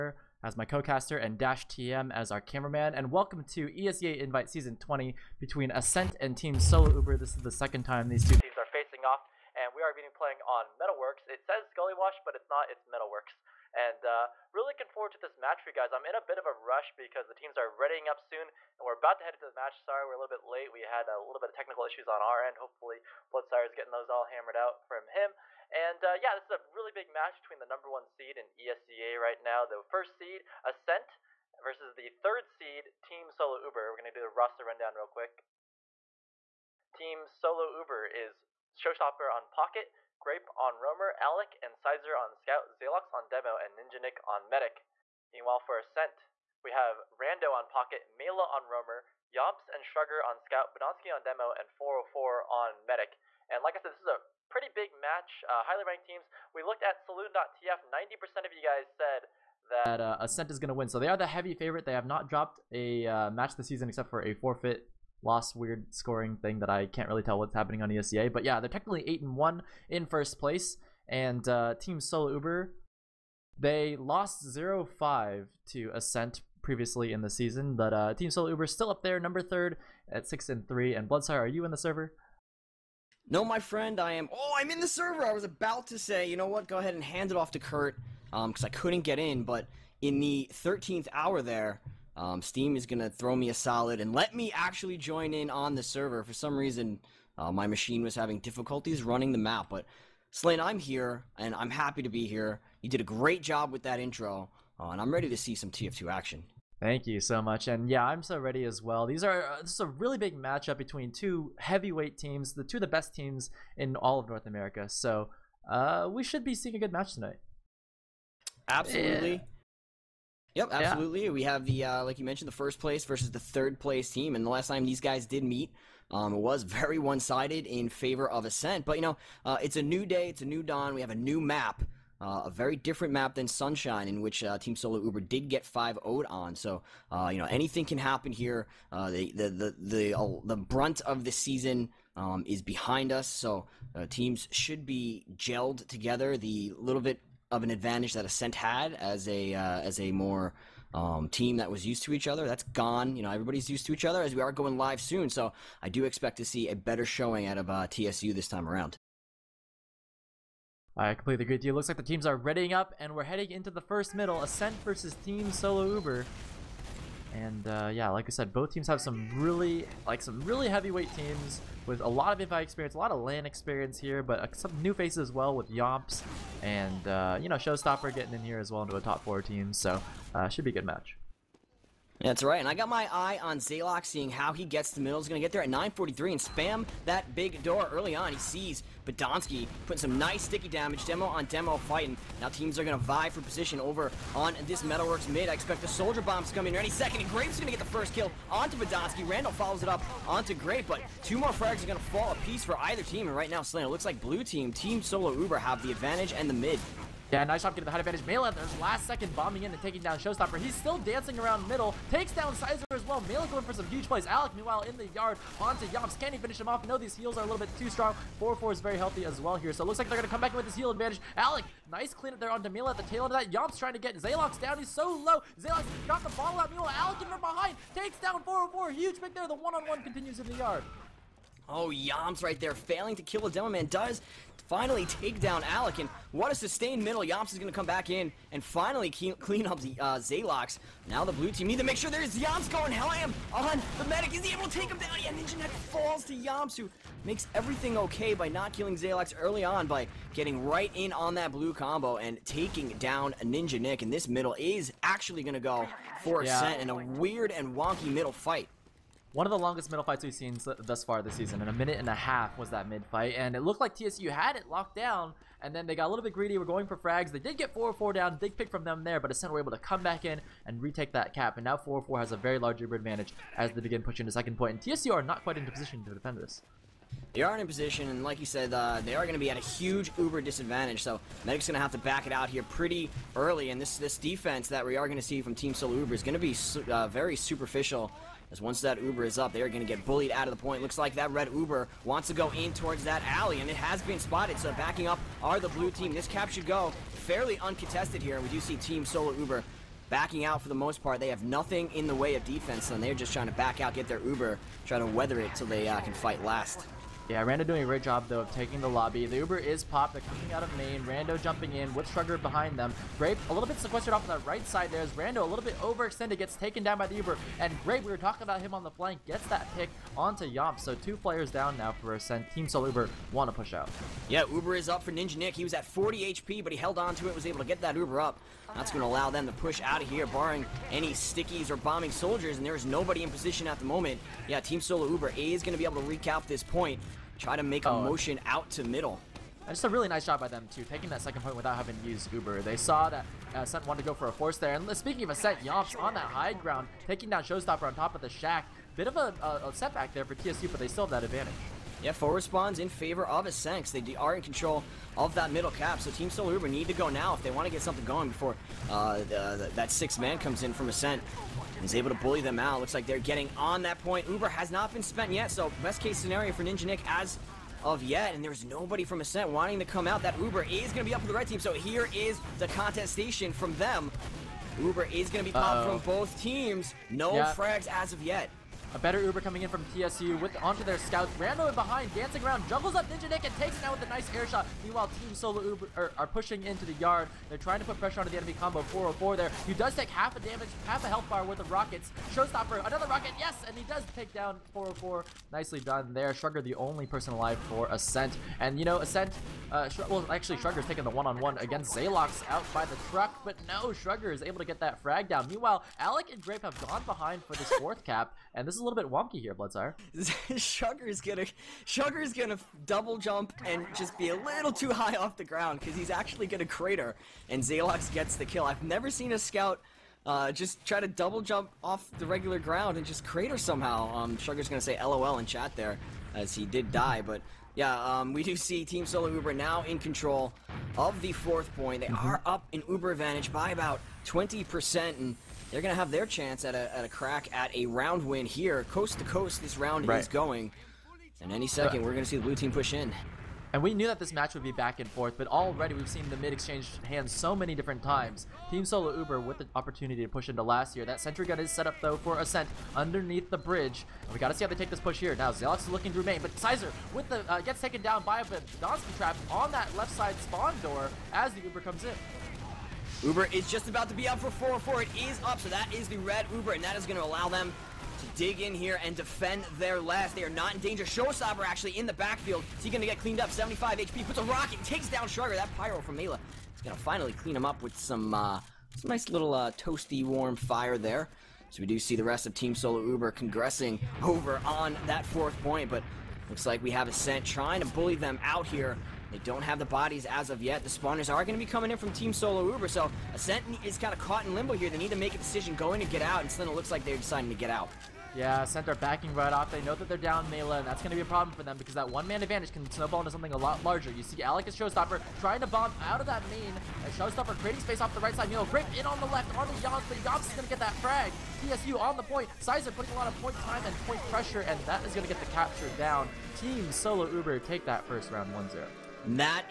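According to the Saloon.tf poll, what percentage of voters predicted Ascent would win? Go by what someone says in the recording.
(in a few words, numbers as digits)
90%.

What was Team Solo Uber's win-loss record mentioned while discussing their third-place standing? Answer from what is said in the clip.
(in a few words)
6 and 3.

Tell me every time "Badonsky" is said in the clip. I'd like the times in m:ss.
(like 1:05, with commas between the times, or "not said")
3:09, 3:18.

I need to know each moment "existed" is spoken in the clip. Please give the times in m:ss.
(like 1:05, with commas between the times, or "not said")
not said.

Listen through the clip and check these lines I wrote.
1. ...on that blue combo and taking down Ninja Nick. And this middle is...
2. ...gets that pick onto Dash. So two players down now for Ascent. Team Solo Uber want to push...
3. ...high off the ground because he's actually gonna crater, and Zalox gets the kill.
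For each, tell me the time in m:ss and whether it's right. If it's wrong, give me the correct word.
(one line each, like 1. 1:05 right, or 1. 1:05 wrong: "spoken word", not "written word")
1. 4:11 right
2. 5:19 wrong: "Yomp", not "Dash"
3. 6:54 right.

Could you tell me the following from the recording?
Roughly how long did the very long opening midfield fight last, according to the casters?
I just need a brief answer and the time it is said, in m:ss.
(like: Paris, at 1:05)
a minute and a half, at 4:21.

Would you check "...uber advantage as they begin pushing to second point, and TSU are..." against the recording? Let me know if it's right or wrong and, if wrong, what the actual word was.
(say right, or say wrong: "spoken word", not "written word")
right.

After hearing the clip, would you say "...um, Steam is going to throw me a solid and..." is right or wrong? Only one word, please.
right.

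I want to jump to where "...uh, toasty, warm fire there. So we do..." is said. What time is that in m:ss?
7:59.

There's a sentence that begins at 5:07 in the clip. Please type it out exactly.
Yeah, Rando doing a great job, though, of taking the lobby.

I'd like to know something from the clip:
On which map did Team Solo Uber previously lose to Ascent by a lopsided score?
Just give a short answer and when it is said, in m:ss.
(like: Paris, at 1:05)
Sunshine, at 2:13.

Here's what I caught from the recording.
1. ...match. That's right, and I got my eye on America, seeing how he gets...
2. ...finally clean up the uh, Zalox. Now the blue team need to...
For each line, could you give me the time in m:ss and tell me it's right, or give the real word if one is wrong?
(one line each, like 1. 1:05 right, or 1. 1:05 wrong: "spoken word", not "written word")
1. 3:00 wrong: "Zalox", not "America"
2. 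3:58 right.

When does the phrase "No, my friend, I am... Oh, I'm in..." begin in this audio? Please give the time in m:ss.
1:23.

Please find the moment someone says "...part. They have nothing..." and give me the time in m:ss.
5:01.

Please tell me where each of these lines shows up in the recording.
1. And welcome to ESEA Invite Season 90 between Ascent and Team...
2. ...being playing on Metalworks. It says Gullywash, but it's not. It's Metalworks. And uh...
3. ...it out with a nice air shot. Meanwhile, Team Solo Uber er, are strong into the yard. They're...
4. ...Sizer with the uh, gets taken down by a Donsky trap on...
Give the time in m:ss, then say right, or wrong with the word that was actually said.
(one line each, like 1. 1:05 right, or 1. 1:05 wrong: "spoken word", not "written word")
1. 0:02 wrong: "20", not "90"
2. 0:09 right
3. 6:23 wrong: "pushing", not "strong"
4. 7:36 right.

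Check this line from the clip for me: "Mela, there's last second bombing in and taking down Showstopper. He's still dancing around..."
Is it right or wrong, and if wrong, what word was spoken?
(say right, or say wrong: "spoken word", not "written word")
right.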